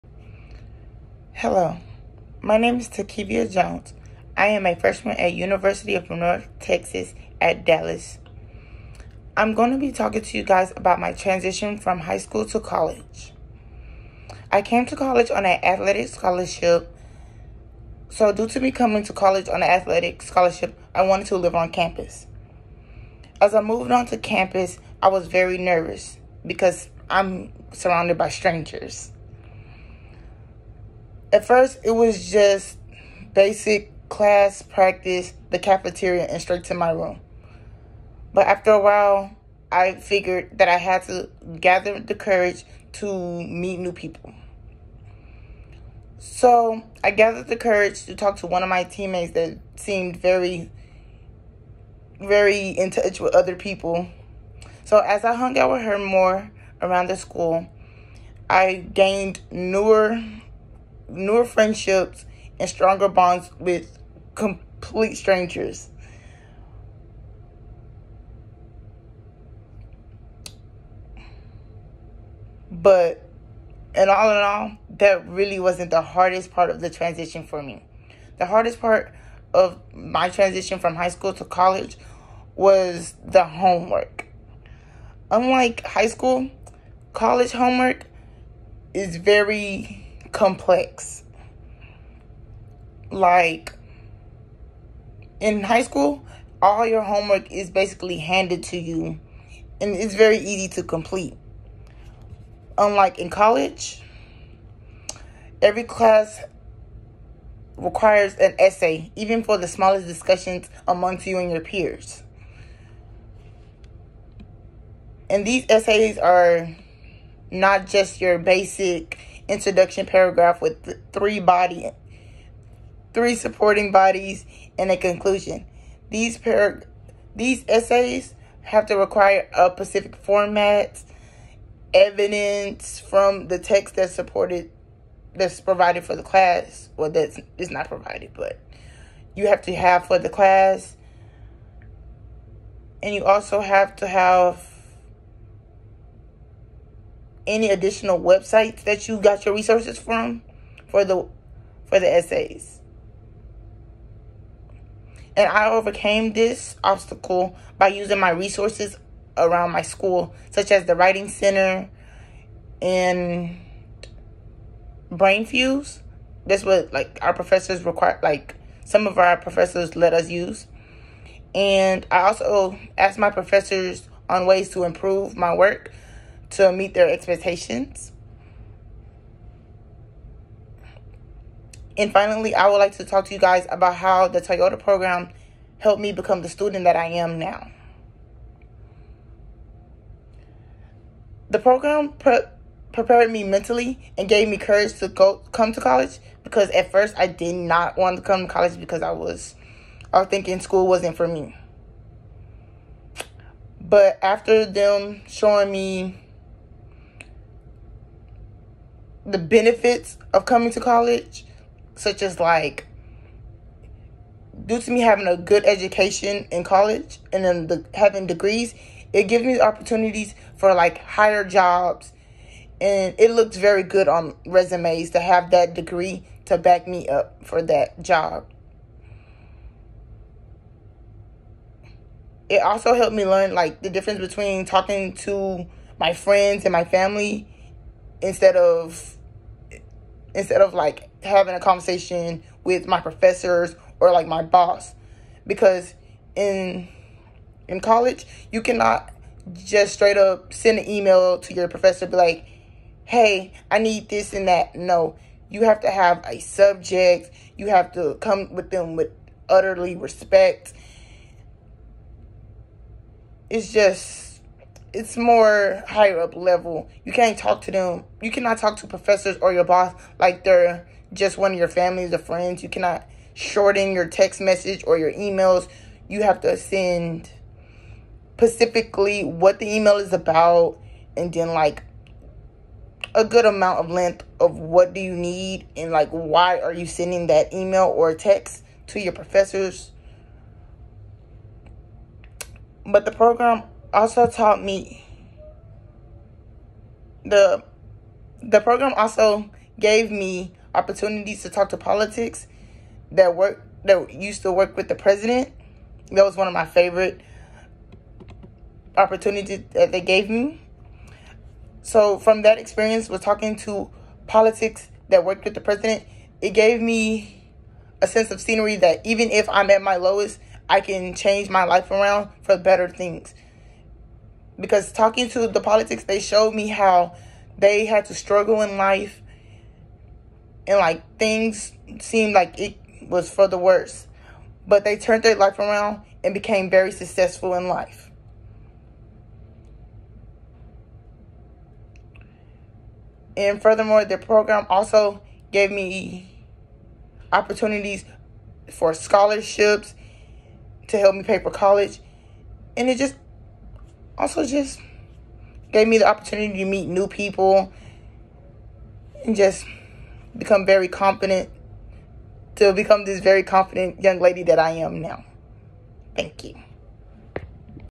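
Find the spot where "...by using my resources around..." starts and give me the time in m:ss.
2:37.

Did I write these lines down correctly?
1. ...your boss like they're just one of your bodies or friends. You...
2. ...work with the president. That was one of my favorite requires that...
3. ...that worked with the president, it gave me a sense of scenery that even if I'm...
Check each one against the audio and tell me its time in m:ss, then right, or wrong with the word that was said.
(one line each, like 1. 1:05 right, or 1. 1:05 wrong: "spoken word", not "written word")
1. 4:29 wrong: "families", not "bodies"
2. 5:04 wrong: "opportunities", not "requires"
3. 5:15 right.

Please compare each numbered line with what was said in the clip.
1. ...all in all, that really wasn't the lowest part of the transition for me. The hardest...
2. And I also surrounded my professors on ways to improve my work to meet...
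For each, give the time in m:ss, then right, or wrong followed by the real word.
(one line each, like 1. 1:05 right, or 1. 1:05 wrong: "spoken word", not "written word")
1. 1:14 wrong: "hardest", not "lowest"
2. 2:51 wrong: "asked", not "surrounded".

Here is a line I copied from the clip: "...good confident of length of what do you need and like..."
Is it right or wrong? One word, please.
wrong.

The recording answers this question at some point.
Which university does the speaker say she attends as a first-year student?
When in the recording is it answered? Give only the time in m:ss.
0:05.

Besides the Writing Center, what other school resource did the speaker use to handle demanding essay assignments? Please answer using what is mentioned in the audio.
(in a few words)
Brainfuse.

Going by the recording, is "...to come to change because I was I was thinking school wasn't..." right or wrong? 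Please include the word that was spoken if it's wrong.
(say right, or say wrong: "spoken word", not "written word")
wrong: "college", not "change".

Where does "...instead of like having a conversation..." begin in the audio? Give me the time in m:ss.
4:00.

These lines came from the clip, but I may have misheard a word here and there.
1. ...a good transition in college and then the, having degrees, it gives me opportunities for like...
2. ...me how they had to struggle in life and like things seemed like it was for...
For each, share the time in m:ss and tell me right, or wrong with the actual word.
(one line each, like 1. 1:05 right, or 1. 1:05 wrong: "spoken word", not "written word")
1. 3:35 wrong: "education", not "transition"
2. 5:26 right.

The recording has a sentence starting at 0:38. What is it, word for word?
But after a while, I figured that I had to gather the courage to meet new people.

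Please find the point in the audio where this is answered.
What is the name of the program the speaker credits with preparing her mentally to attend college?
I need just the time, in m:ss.
3:04.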